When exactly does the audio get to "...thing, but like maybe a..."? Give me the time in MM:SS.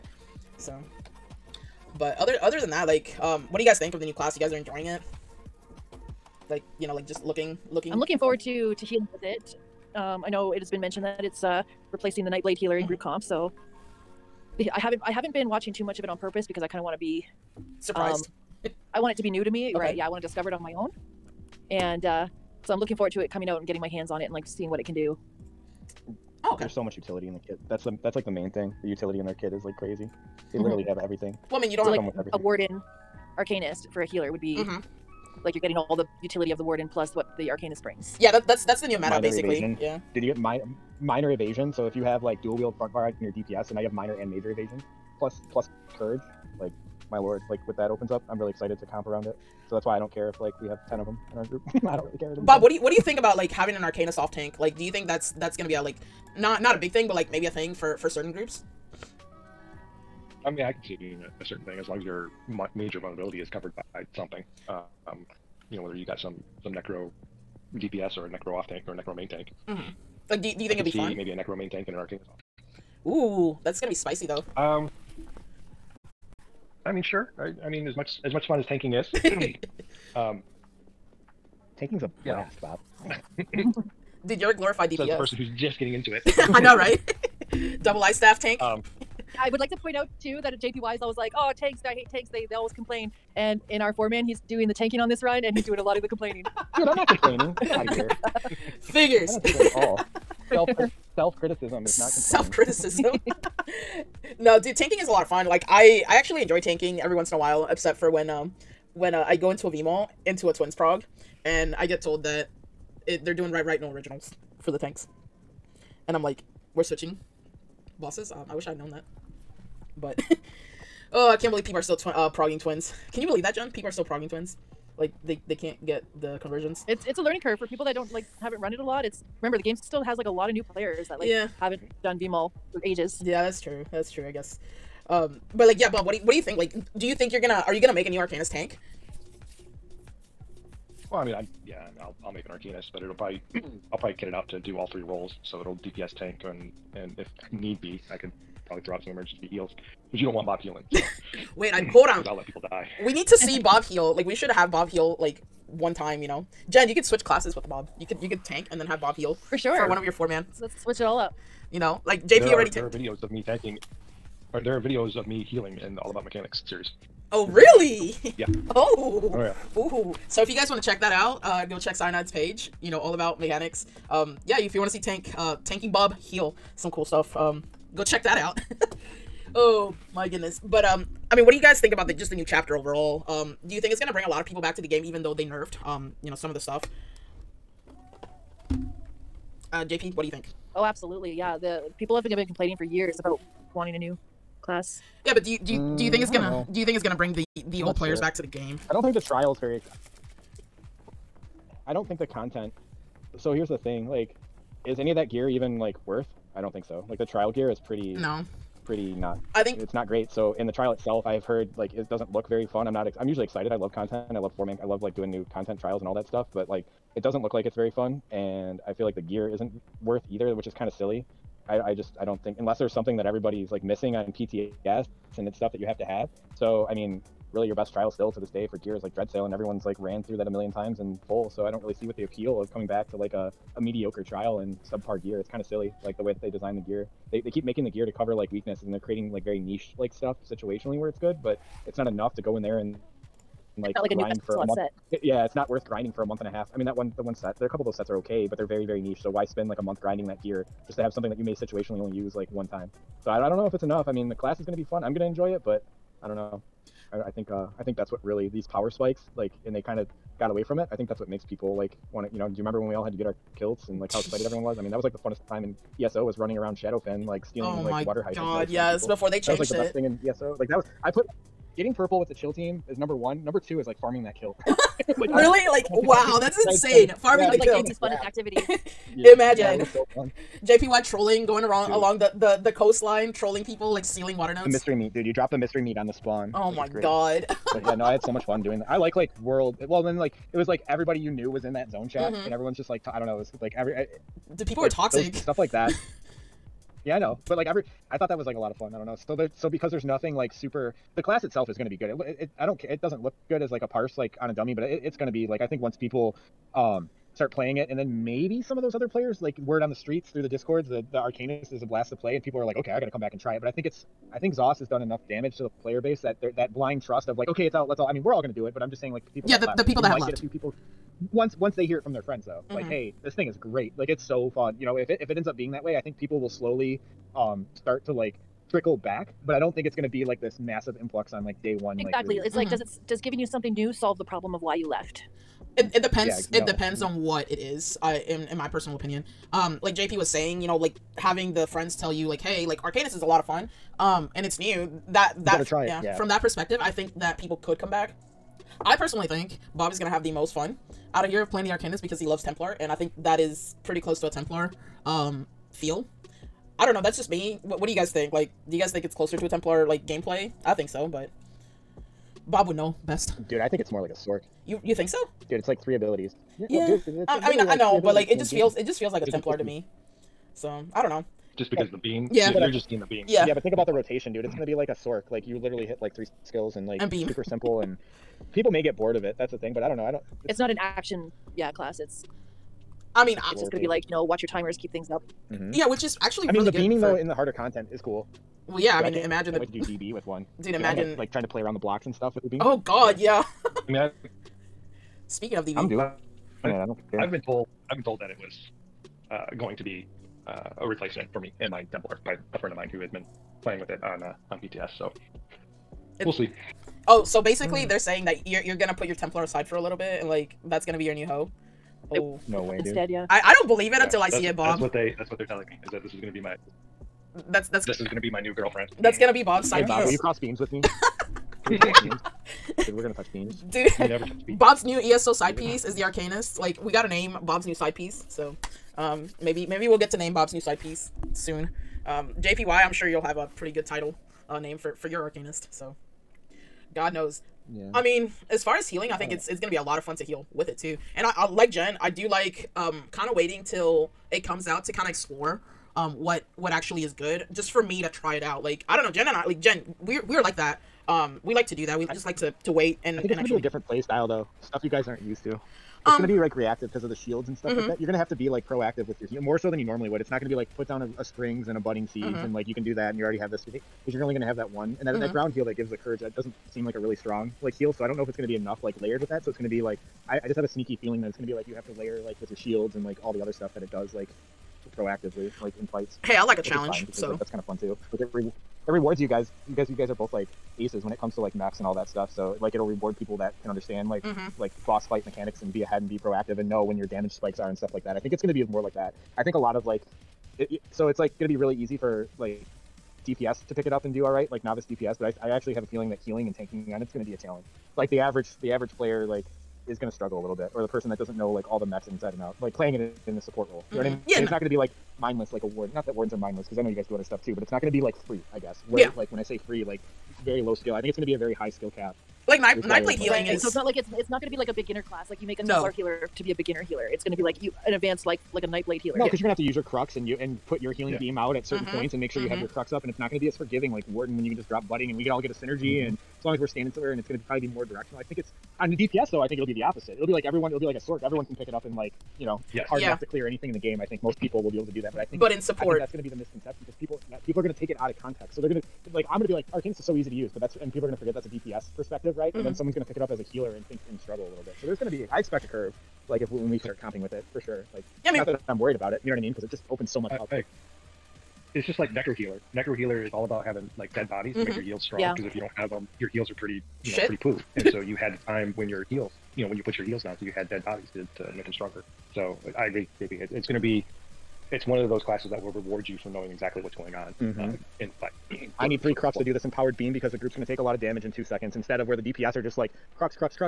00:56.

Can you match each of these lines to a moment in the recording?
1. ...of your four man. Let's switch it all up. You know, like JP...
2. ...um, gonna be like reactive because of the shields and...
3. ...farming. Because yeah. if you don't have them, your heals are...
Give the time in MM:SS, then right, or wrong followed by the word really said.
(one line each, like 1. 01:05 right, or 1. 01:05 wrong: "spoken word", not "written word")
1. 02:39 right
2. 07:36 right
3. 09:15 wrong: "strong", not "farming".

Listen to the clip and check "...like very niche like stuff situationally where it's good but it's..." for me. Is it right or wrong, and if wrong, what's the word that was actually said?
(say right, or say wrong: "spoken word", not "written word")
right.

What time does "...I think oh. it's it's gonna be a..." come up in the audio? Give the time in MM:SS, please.
07:19.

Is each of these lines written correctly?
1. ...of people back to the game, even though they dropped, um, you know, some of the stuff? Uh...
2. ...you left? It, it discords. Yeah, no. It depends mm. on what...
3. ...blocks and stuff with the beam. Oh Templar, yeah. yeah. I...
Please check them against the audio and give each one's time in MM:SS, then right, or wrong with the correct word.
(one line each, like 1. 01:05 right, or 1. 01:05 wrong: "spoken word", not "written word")
1. 03:04 wrong: "nerfed", not "dropped"
2. 05:34 wrong: "depends", not "discords"
3. 06:31 wrong: "God", not "Templar".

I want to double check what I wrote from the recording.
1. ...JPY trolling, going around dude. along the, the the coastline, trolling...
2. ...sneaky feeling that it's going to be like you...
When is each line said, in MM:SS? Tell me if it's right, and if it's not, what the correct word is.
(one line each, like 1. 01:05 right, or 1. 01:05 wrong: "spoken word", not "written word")
1. 04:40 right
2. 07:50 right.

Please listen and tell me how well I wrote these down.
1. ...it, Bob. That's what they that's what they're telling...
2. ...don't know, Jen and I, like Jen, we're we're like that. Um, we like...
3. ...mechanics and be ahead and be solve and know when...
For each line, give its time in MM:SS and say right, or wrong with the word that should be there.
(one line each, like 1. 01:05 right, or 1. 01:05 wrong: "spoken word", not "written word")
1. 06:54 right
2. 07:28 right
3. 08:05 wrong: "proactive", not "solve".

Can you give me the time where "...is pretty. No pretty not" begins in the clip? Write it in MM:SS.
03:27.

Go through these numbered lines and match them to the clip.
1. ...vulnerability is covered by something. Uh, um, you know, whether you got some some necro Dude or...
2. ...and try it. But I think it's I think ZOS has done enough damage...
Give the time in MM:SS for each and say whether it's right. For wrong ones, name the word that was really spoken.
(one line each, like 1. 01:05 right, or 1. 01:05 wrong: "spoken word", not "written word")
1. 01:02 wrong: "DPS", not "Dude"
2. 05:13 right.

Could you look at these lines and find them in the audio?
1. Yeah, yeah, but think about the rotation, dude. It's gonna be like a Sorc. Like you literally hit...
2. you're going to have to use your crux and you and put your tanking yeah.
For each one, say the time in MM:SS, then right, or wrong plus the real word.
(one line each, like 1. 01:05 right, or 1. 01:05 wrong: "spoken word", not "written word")
1. 06:13 right
2. 08:39 wrong: "healing", not "tanking".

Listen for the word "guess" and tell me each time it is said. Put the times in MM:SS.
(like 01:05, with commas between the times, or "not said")
02:14, 08:28.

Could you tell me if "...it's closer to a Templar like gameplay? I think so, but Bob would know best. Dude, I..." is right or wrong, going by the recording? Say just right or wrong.
right.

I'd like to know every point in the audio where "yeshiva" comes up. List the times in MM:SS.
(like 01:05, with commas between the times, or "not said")
not said.